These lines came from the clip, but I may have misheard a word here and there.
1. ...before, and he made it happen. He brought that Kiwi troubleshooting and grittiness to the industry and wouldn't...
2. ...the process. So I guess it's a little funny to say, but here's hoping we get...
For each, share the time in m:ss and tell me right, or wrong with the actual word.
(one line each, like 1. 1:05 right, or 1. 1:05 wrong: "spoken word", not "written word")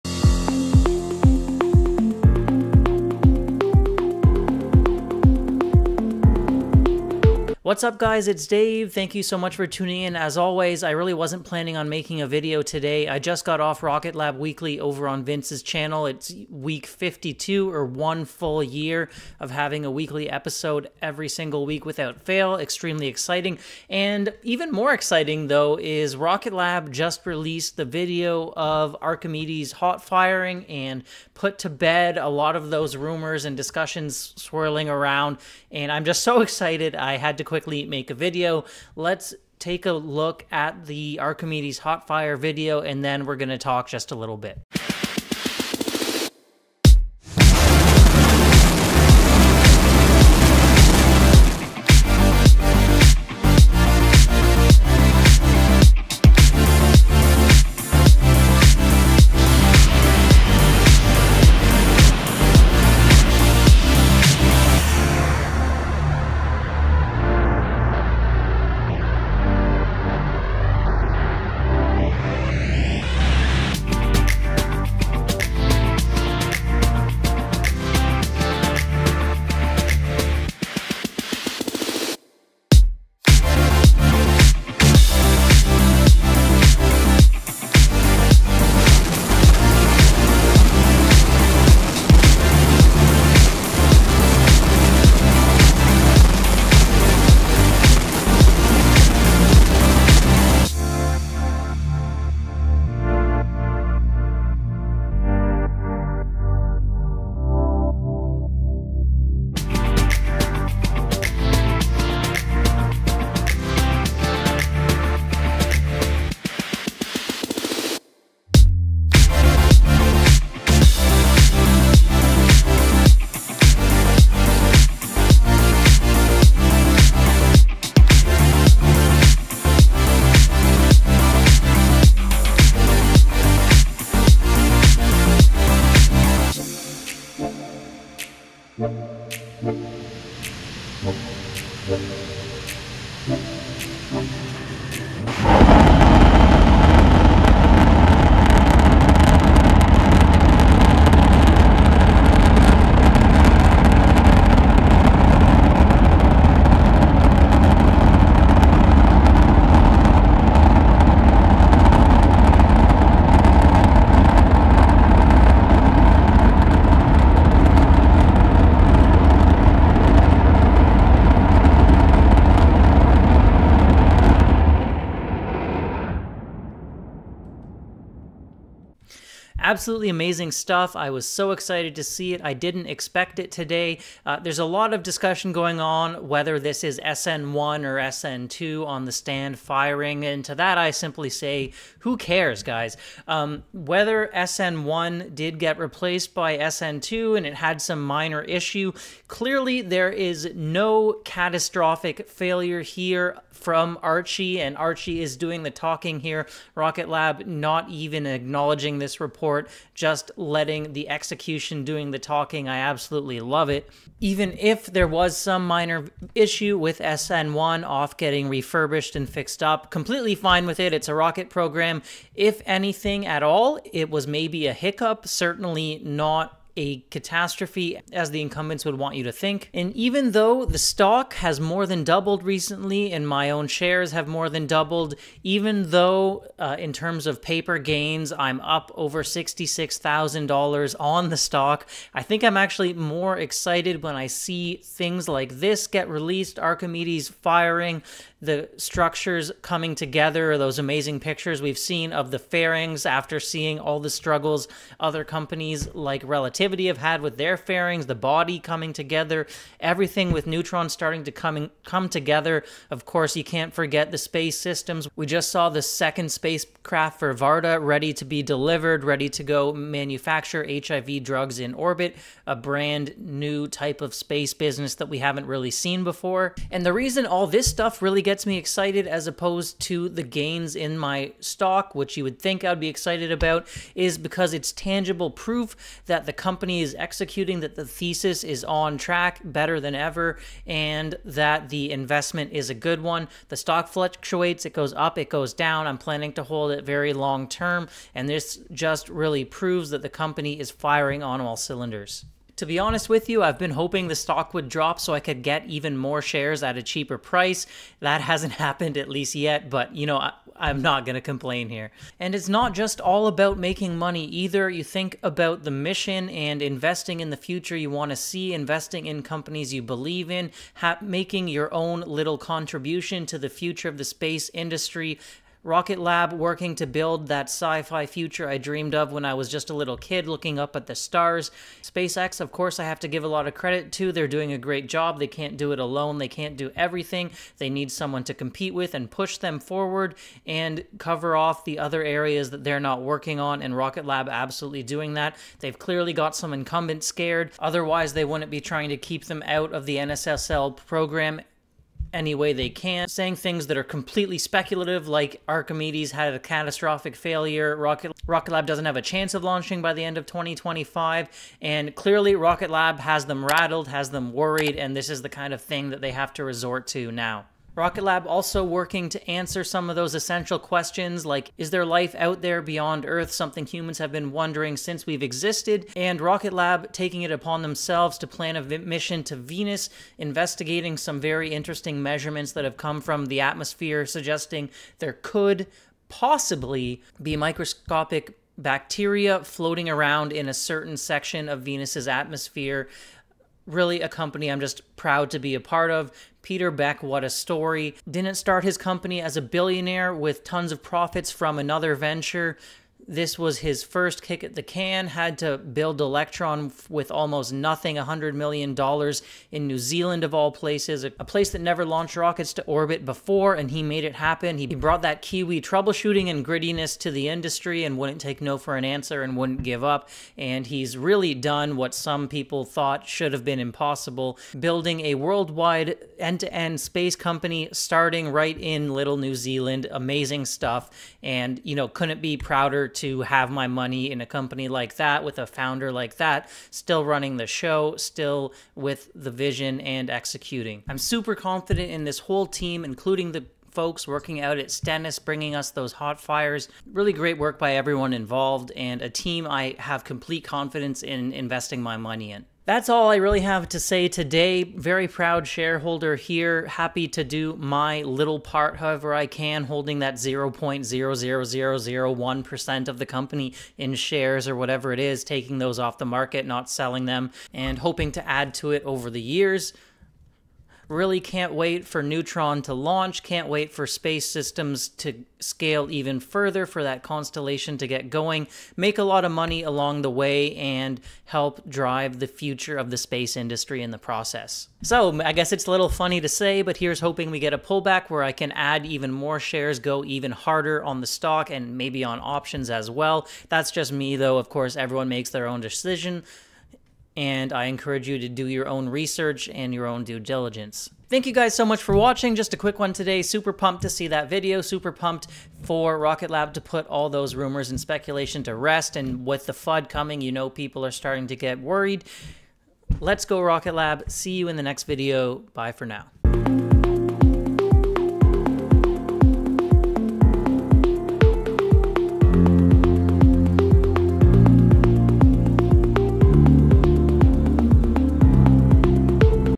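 1. 6:53 right
2. 8:03 right.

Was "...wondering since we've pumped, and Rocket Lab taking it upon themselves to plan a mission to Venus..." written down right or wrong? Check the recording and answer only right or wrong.
wrong.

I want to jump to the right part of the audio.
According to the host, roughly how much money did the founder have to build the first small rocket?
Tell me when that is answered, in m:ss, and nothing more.
6:47.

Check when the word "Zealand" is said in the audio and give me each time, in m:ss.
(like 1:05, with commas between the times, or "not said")
6:49, 7:09.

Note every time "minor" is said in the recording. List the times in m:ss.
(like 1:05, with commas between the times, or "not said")
3:18, 3:35.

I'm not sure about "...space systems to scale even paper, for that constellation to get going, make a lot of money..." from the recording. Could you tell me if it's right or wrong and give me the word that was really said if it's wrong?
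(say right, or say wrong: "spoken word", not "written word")
wrong: "further", not "paper".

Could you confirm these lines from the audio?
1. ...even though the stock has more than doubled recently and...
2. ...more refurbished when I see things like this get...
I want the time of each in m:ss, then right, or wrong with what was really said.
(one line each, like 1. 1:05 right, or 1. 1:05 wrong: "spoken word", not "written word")
1. 3:49 right
2. 4:02 wrong: "excited", not "refurbished".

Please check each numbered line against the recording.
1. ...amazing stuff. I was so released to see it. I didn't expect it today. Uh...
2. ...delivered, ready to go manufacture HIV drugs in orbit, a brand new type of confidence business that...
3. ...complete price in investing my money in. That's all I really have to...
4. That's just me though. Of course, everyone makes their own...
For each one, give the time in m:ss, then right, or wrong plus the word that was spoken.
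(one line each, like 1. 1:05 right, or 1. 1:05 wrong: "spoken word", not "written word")
1. 3:00 wrong: "excited", not "released"
2. 4:28 wrong: "space", not "confidence"
3. 7:30 wrong: "confidence", not "price"
4. 8:13 right.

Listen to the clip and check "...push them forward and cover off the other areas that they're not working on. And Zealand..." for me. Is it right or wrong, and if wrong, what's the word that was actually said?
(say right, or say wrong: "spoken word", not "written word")
wrong: "Rocket", not "Zealand".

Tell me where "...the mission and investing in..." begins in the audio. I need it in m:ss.
5:15.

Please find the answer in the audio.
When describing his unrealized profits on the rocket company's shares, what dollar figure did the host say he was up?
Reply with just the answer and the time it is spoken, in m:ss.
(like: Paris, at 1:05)
$66,000, at 3:59.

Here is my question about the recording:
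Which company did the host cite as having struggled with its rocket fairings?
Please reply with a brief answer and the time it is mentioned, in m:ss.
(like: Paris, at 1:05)
Relativity, at 4:16.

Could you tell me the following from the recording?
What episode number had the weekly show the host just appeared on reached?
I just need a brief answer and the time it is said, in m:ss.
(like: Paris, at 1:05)
52, at 0:16.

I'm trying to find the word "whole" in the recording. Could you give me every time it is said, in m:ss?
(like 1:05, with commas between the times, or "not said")
7:22.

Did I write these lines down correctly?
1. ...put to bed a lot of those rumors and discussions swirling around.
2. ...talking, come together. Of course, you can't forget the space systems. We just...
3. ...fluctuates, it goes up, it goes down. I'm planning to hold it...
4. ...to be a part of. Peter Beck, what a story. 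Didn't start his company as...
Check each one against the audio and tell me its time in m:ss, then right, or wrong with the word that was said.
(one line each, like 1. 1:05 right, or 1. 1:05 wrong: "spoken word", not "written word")
1. 0:31 right
2. 4:21 wrong: "coming", not "talking"
3. 4:53 right
4. 6:35 right.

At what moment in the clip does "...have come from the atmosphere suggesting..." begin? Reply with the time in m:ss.
6:22.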